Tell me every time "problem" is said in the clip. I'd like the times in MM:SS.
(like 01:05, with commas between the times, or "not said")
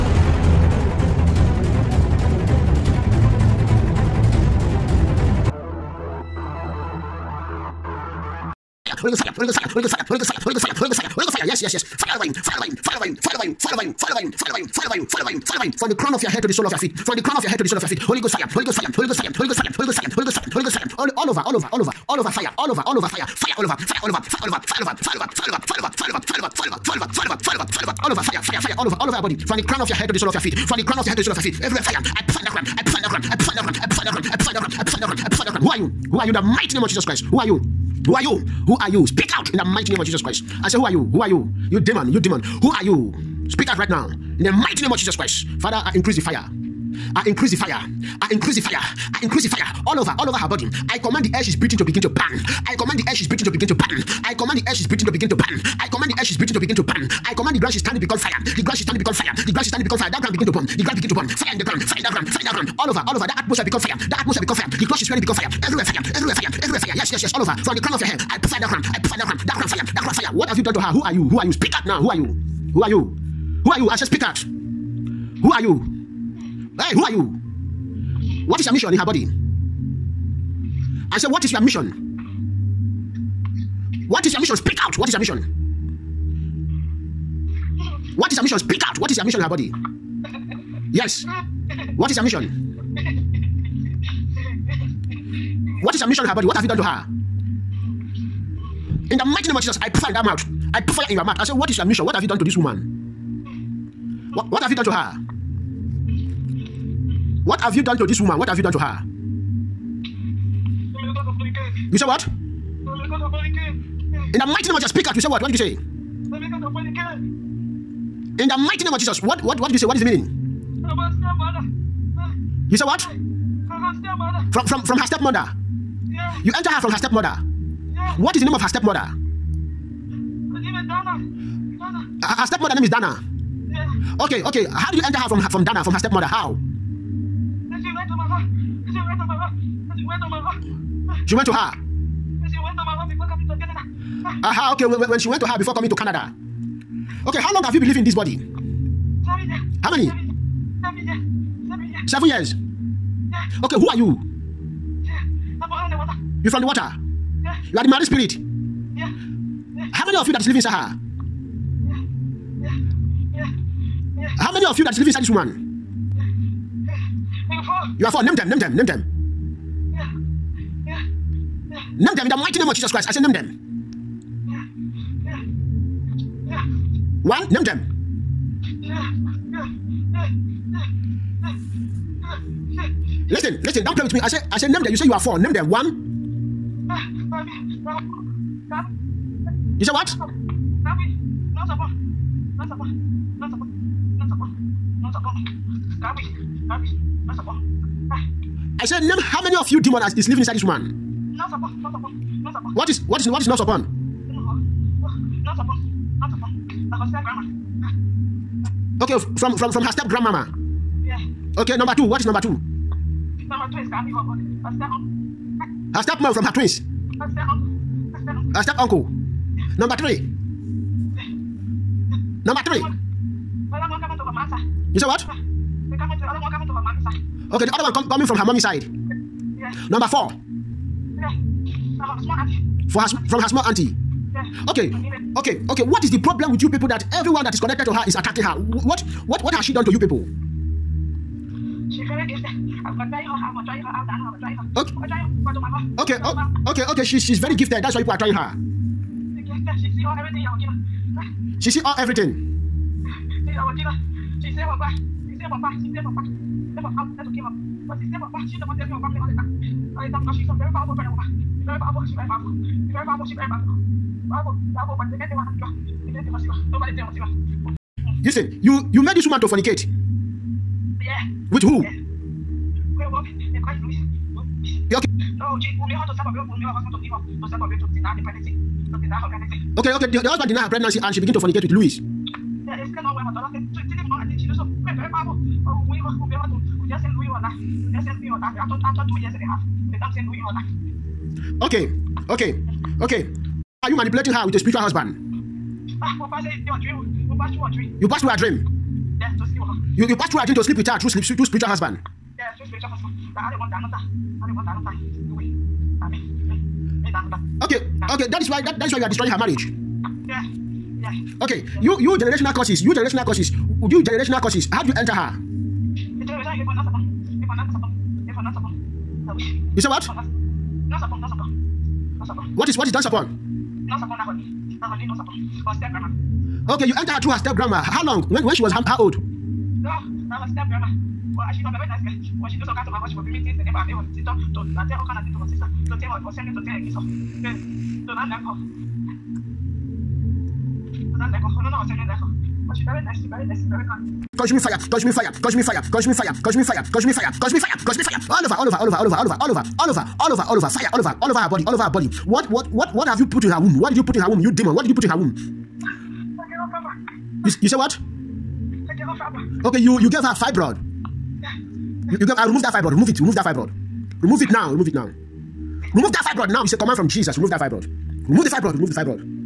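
03:56.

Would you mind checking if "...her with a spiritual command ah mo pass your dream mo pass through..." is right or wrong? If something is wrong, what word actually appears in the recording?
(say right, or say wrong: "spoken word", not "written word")
wrong: "husband", not "command".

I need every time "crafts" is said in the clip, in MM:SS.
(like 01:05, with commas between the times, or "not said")
not said.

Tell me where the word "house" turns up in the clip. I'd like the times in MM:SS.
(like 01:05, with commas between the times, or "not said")
05:32.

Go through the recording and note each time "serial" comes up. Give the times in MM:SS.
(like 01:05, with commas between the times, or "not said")
not said.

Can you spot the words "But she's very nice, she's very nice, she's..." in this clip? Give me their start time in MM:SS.
05:42.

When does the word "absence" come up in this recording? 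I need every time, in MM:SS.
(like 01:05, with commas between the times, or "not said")
not said.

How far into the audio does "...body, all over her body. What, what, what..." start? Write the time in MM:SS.
05:51.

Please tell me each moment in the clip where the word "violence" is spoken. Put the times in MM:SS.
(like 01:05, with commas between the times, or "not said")
not said.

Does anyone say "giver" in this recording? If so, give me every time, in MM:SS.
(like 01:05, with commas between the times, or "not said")
04:13.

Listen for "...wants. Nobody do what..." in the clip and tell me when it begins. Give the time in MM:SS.
04:26.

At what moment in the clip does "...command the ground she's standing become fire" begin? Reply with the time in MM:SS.
00:57.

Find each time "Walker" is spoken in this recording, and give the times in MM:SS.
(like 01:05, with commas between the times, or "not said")
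not said.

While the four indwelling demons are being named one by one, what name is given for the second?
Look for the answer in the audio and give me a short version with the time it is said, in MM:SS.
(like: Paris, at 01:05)
Gabby, at 03:33.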